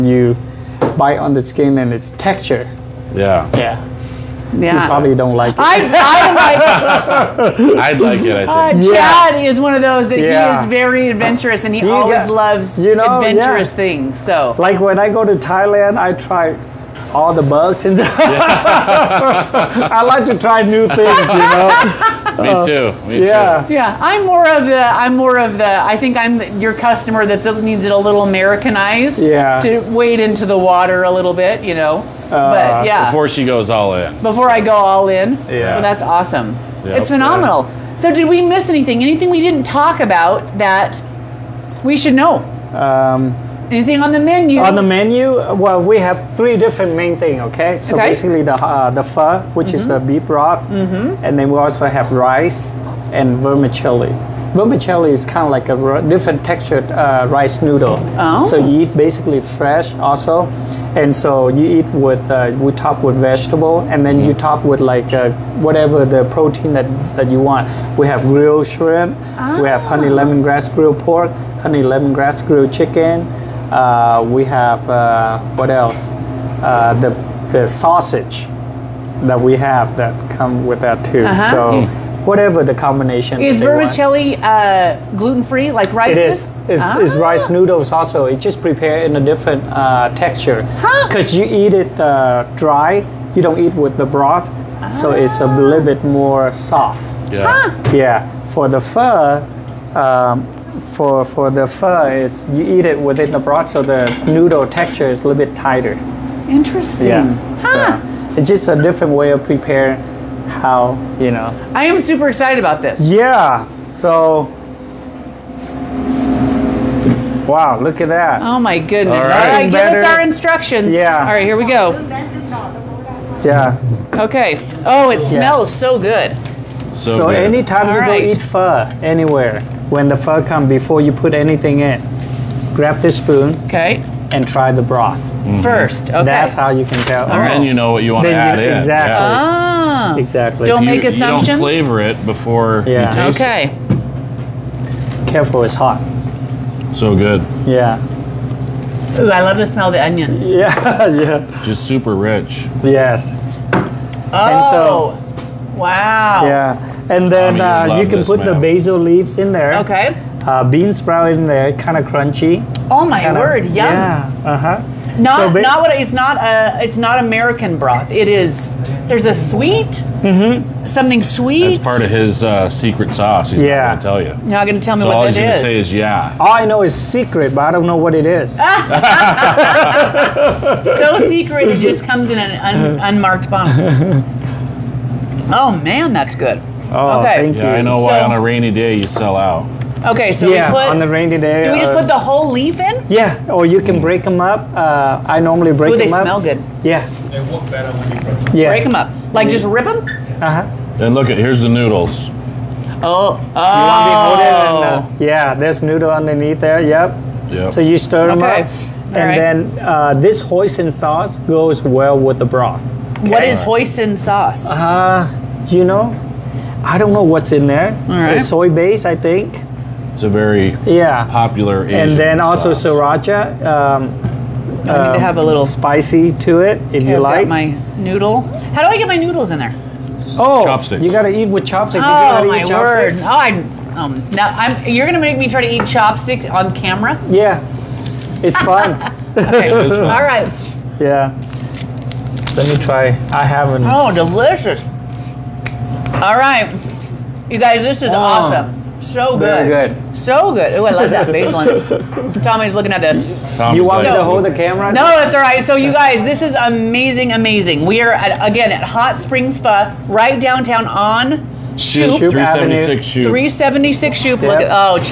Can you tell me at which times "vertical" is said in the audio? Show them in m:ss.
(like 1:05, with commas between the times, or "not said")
not said.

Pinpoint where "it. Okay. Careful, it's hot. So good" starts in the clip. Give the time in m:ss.
2:23.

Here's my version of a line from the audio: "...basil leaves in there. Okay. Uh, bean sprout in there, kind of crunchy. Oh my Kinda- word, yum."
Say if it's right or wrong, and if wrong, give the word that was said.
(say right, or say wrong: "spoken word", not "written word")
right.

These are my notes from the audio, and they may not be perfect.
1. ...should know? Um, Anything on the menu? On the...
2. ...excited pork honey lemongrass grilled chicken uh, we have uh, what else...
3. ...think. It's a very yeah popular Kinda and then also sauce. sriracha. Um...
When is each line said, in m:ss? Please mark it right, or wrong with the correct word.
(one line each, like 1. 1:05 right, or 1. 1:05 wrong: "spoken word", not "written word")
1. 0:41 right
2. 1:10 wrong: "grilled", not "excited"
3. 3:39 wrong: "Asian", not "Kinda".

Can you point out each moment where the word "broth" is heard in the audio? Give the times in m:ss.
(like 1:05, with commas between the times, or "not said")
0:50, 1:34, 1:43, 2:14, 2:47, 3:32.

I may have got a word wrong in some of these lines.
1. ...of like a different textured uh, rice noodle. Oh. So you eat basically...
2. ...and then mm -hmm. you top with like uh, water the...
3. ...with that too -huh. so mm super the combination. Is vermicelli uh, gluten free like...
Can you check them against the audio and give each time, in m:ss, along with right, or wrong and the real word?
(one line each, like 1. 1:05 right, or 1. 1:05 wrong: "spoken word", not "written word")
1. 0:55 right
2. 1:03 wrong: "whatever", not "water"
3. 1:20 wrong: "whatever", not "super".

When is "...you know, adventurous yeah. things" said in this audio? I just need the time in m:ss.
0:12.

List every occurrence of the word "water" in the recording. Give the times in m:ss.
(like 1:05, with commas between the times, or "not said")
0:30.